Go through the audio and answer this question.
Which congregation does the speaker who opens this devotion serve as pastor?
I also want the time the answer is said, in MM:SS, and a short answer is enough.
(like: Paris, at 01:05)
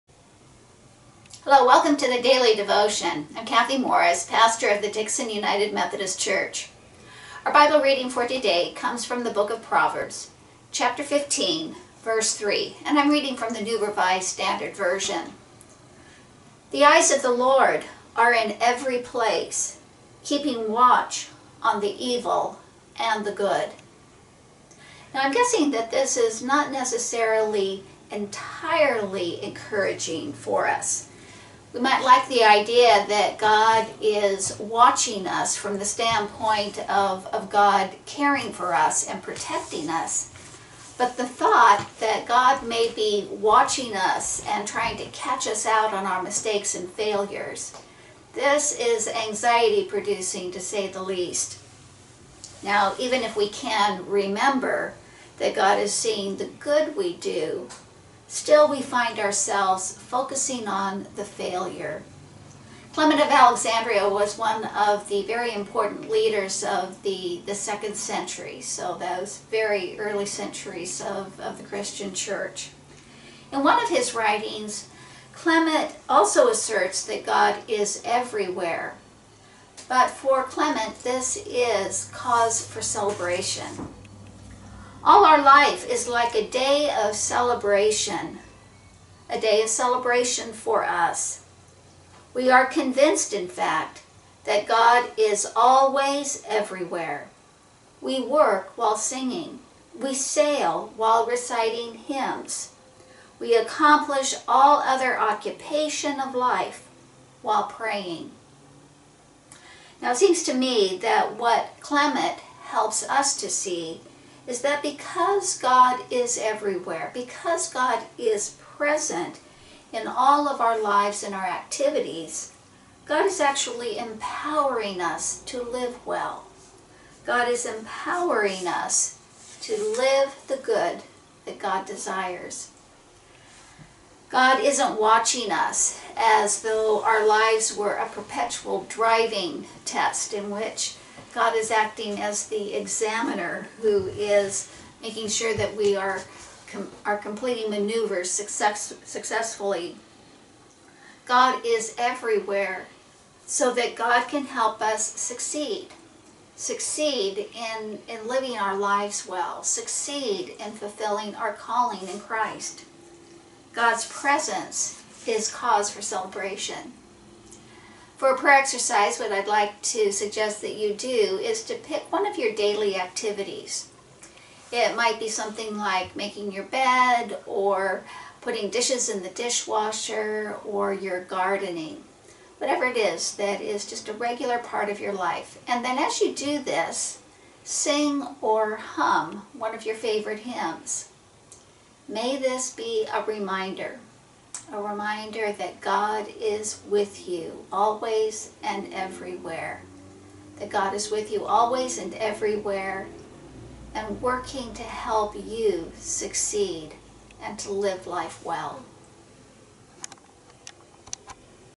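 Dixon United Methodist Church, at 00:04.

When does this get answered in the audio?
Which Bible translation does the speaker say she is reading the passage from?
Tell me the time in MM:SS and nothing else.
00:13.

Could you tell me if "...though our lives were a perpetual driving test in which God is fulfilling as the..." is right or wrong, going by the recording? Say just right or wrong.
wrong.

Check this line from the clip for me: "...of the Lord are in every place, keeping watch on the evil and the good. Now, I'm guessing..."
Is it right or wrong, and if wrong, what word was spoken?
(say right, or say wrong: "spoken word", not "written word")
right.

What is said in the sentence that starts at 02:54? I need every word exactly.
It might be something like making your bed or putting dishes in the dishwasher or your gardening.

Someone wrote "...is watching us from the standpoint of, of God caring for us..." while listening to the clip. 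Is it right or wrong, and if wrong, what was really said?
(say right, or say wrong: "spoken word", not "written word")
right.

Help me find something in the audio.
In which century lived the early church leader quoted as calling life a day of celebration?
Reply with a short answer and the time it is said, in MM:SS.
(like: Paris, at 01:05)
Second century, at 01:07.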